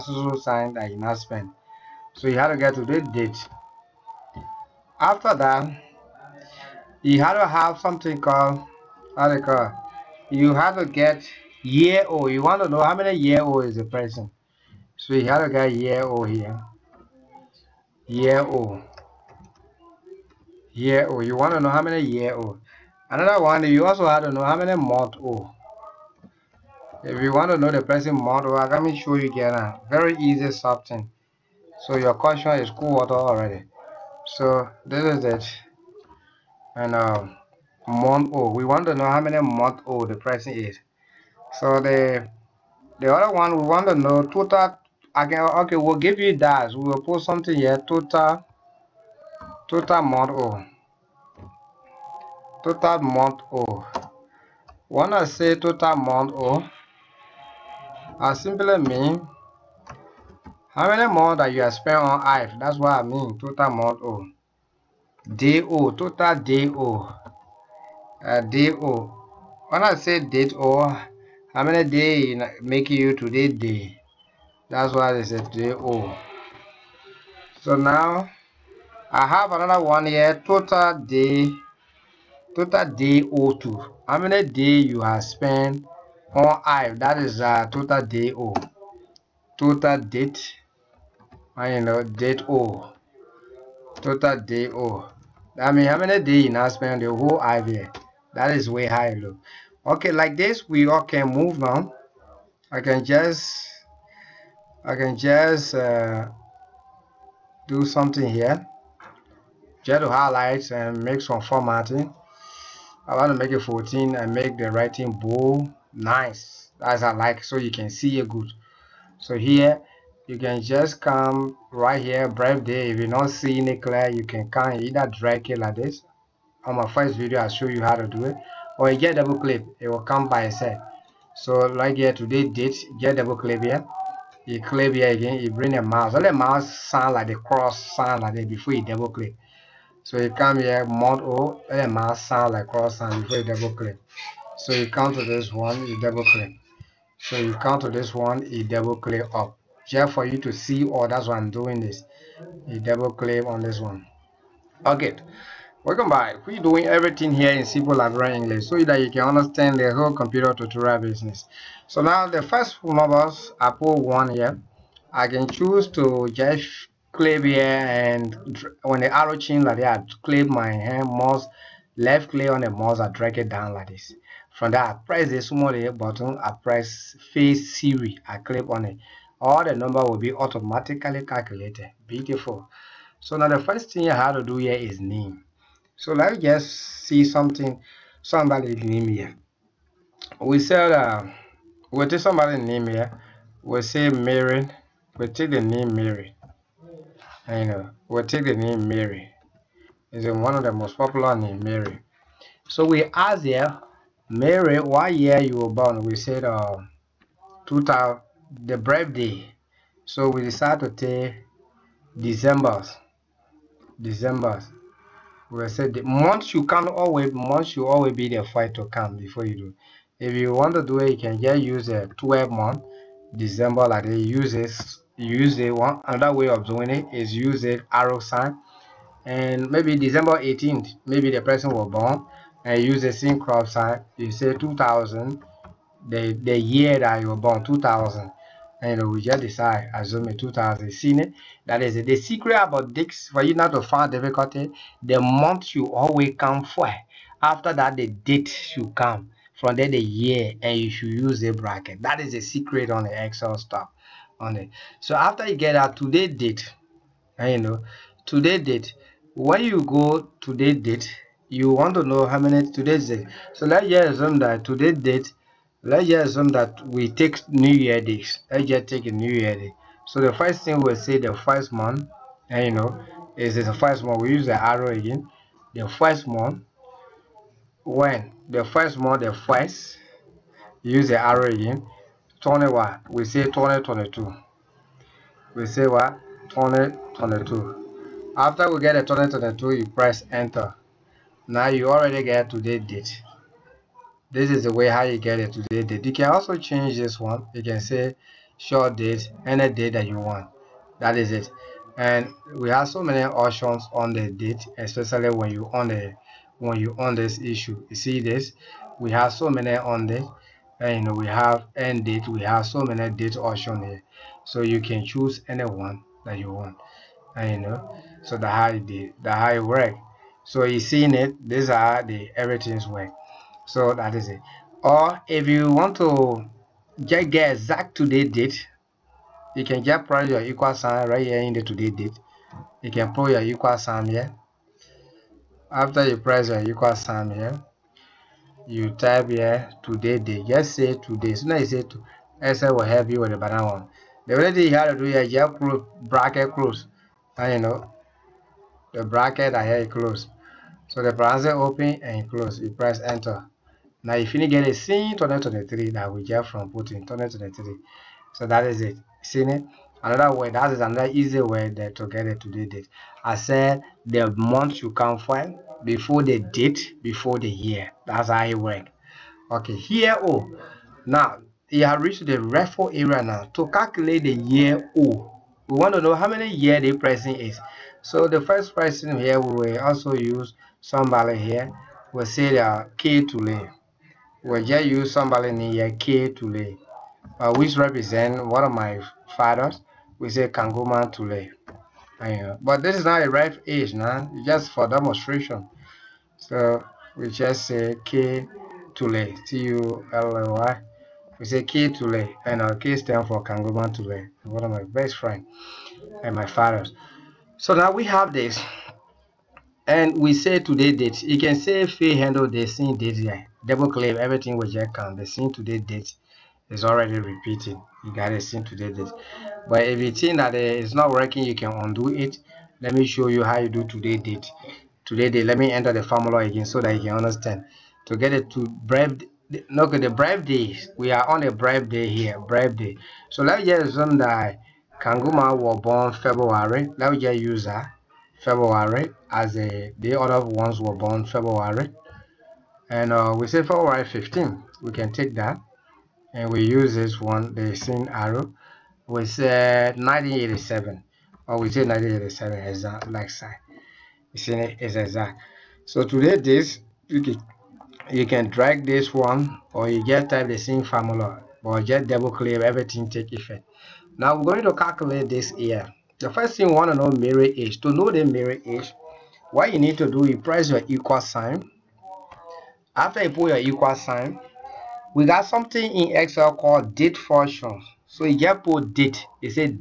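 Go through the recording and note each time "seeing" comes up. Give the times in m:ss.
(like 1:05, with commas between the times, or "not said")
2:03.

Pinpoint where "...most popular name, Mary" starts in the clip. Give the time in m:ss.
3:20.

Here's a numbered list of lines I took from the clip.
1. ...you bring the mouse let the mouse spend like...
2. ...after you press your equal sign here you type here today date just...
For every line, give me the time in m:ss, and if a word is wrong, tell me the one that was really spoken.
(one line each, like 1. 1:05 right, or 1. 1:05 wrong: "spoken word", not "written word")
1. 2:15 wrong: "sound", not "spend"
2. 5:35 right.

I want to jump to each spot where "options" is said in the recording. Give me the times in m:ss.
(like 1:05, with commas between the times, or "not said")
5:03, 5:13.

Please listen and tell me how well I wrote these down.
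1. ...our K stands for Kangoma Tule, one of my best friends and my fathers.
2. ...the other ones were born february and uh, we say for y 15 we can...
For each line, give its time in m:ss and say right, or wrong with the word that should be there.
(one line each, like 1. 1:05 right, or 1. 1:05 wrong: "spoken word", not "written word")
1. 6:42 right
2. 7:19 right.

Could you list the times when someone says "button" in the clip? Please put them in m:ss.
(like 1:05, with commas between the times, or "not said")
2:55.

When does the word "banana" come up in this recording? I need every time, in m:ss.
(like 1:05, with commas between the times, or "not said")
5:43.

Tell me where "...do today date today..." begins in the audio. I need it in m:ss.
7:03.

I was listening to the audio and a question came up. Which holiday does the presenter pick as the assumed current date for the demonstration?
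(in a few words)
New Year's Day.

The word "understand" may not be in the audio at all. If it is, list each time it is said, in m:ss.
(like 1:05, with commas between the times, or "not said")
2:39, 7:07.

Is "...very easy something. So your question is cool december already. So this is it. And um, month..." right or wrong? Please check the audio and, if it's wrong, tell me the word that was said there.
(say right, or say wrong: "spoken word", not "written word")
wrong: "water", not "december".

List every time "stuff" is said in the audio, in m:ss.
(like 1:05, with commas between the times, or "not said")
4:13.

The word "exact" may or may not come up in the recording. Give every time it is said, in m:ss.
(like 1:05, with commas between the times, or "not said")
5:27, 7:34.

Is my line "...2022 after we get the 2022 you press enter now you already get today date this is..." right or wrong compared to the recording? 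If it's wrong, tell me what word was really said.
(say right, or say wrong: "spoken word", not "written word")
right.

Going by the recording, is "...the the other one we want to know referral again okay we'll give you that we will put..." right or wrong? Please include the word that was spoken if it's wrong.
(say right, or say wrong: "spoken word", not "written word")
wrong: "total", not "referral".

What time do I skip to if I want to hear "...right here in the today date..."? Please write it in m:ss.
5:31.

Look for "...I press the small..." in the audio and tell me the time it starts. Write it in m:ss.
2:54.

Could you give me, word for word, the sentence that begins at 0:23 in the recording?
Another one, you also have to know how many month old.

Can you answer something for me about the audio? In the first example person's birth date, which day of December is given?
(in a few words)
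18th.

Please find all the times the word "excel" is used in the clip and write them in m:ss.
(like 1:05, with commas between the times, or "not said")
4:13, 5:42, 7:56.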